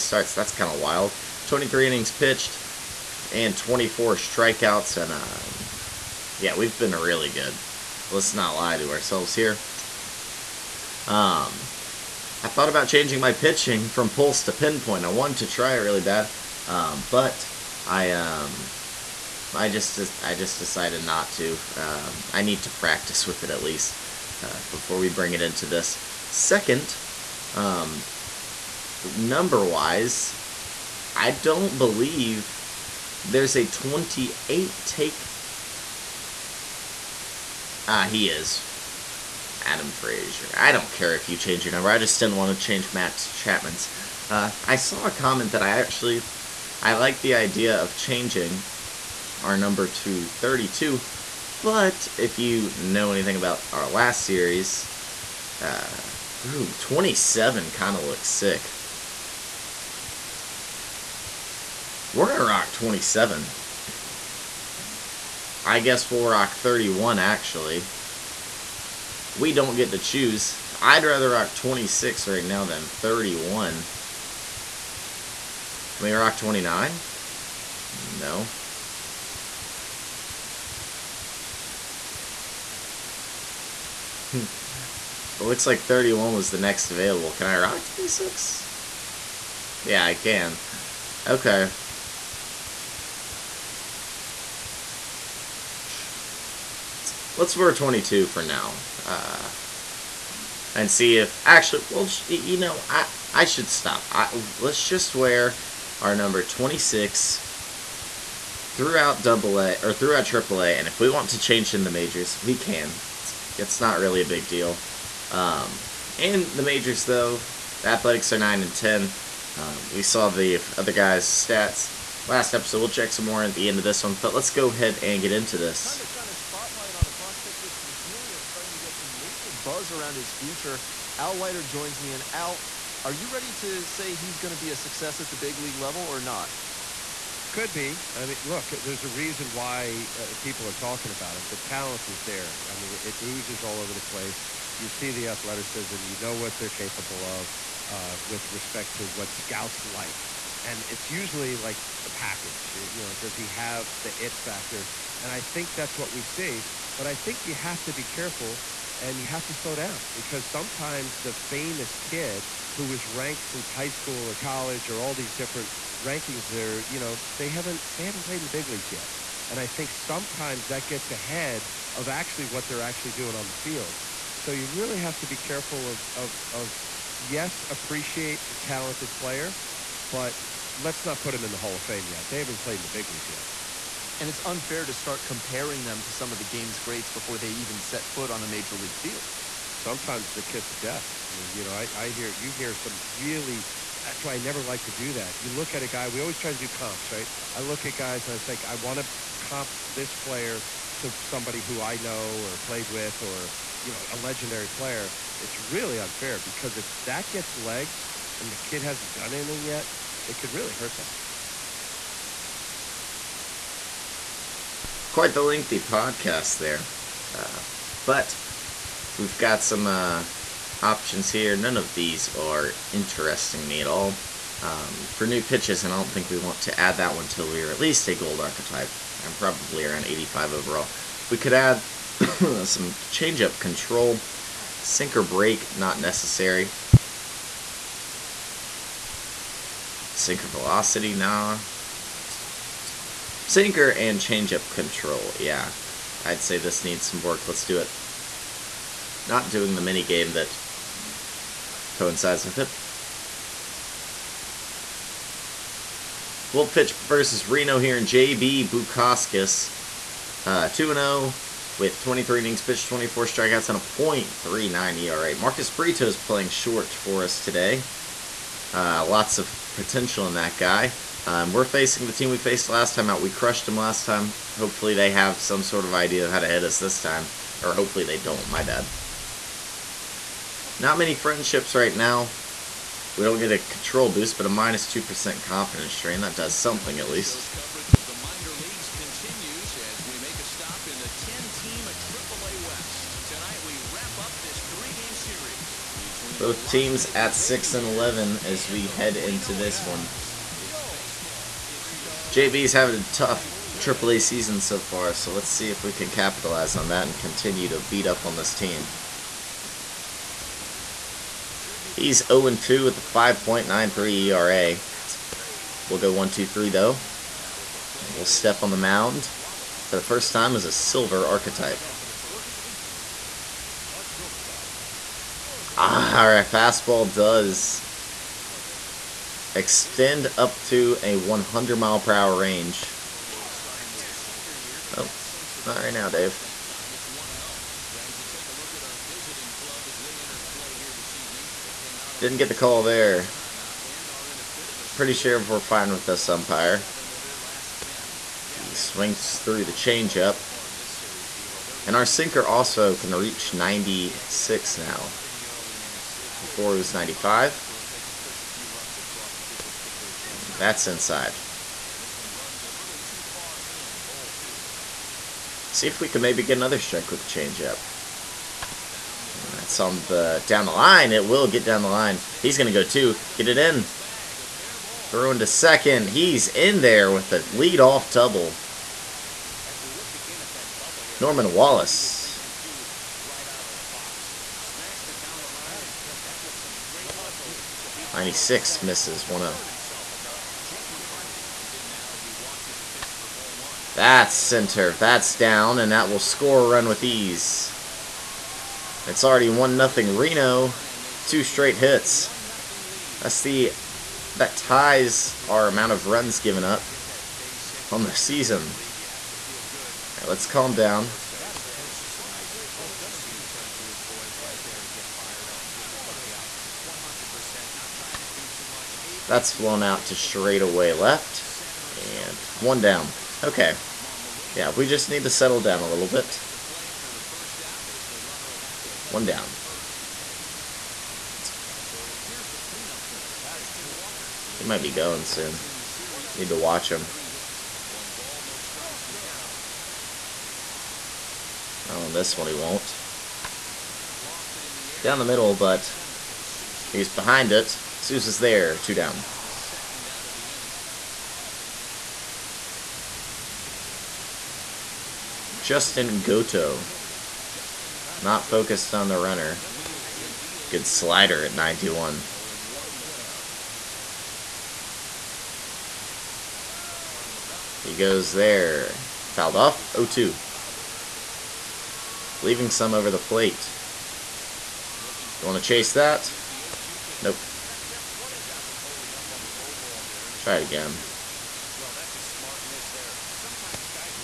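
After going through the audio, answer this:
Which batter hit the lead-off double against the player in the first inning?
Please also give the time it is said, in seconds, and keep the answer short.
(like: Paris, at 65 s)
Norman Wallace, at 381 s.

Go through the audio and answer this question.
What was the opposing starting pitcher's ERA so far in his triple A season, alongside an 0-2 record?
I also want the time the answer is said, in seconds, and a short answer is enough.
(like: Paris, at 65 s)
5.93, at 312 s.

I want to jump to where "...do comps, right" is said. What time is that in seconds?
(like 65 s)
196 s.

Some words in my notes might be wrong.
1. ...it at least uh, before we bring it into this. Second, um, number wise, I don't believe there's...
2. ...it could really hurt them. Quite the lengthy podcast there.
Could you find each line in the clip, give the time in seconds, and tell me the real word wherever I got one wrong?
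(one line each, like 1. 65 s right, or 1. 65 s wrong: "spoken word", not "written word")
1. 23 s right
2. 210 s right.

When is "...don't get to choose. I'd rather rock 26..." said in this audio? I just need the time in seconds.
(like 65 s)
69 s.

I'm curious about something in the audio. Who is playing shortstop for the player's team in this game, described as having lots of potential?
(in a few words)
Marcus Brito.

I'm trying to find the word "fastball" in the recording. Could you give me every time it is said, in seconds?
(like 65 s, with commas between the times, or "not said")
326 s.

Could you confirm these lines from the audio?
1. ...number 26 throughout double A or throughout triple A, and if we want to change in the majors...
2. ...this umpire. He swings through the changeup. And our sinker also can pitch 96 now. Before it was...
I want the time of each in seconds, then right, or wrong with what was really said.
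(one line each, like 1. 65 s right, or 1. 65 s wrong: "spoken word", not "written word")
1. 106 s right
2. 346 s wrong: "reach", not "pitch".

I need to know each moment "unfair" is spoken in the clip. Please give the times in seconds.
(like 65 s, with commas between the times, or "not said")
184 s, 205 s.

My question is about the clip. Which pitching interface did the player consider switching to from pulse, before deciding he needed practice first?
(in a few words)
Pinpoint.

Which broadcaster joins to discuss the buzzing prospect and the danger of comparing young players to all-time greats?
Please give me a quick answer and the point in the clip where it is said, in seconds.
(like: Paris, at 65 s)
Al Leiter, at 131 s.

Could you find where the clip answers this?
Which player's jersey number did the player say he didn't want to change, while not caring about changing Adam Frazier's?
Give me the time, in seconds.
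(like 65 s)
42 s.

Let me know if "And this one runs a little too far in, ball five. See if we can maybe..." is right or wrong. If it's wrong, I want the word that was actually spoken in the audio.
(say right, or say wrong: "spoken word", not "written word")
wrong: "two", not "five".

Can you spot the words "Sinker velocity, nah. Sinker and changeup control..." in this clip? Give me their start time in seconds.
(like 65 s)
240 s.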